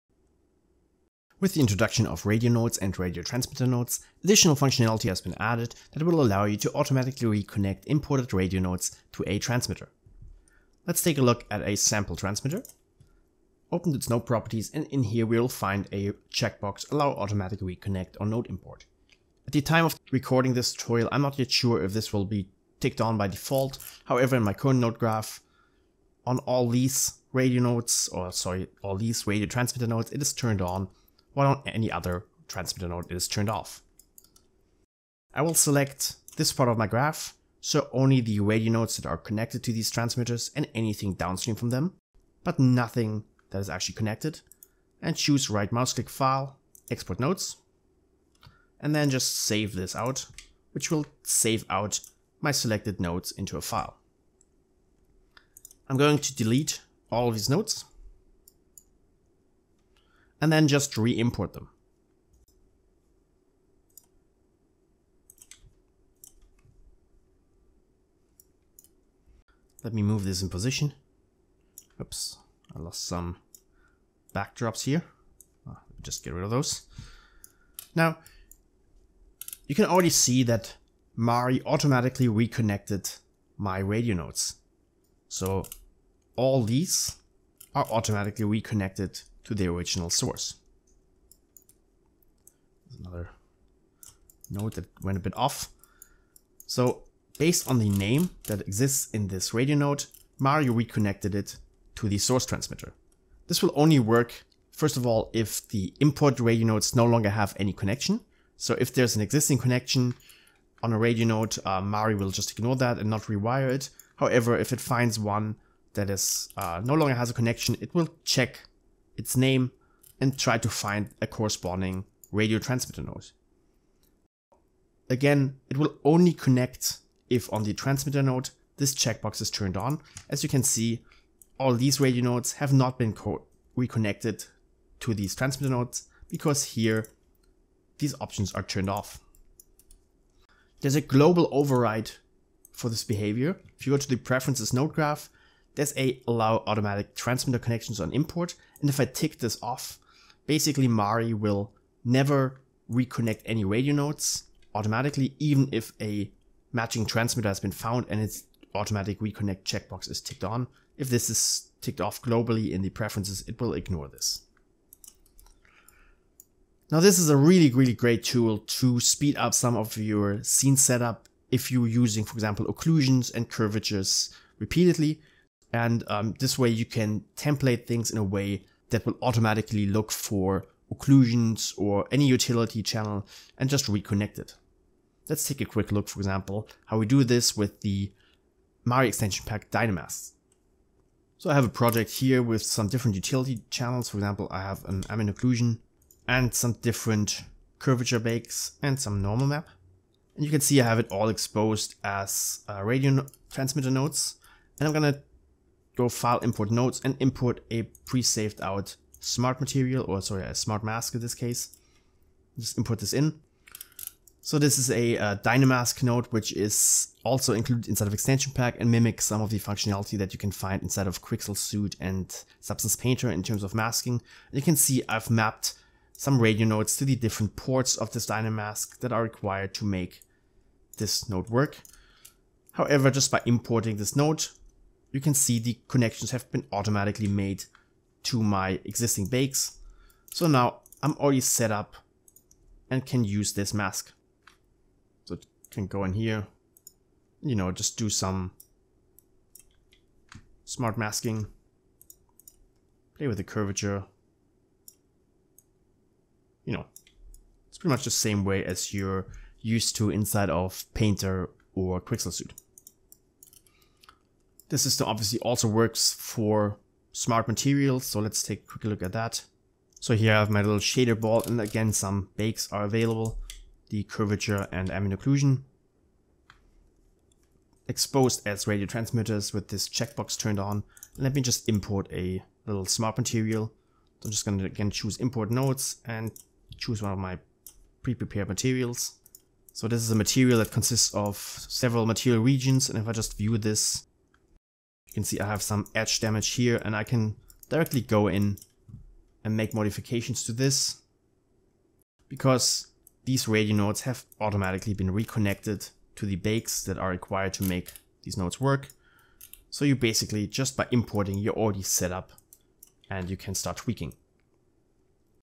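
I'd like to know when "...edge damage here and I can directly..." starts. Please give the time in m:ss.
4:55.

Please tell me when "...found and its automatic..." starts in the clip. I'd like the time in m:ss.
2:37.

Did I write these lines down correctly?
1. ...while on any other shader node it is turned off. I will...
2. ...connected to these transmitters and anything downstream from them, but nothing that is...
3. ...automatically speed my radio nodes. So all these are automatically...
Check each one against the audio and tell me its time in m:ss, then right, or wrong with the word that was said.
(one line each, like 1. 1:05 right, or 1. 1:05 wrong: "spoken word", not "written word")
1. 0:31 wrong: "transmitter", not "shader"
2. 0:39 right
3. 1:21 wrong: "reconnected", not "speed".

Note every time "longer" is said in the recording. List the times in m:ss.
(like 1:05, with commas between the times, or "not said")
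1:47, 1:56.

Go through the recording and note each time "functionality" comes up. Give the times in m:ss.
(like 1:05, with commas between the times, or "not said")
0:04, 3:39.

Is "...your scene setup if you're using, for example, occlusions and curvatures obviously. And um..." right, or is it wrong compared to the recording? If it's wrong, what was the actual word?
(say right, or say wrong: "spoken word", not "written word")
wrong: "repeatedly", not "obviously".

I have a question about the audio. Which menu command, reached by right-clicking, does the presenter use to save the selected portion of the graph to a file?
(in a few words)
Export nodes.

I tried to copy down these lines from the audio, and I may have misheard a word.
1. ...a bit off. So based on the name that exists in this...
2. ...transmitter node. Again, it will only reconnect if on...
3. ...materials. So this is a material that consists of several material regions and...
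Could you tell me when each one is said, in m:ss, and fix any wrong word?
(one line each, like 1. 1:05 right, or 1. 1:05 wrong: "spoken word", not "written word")
1. 1:35 right
2. 2:02 wrong: "connect", not "reconnect"
3. 4:48 right.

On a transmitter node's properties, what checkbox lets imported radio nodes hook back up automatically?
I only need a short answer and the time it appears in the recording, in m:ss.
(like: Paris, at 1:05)
Allow automatic reconnect on node import, at 0:16.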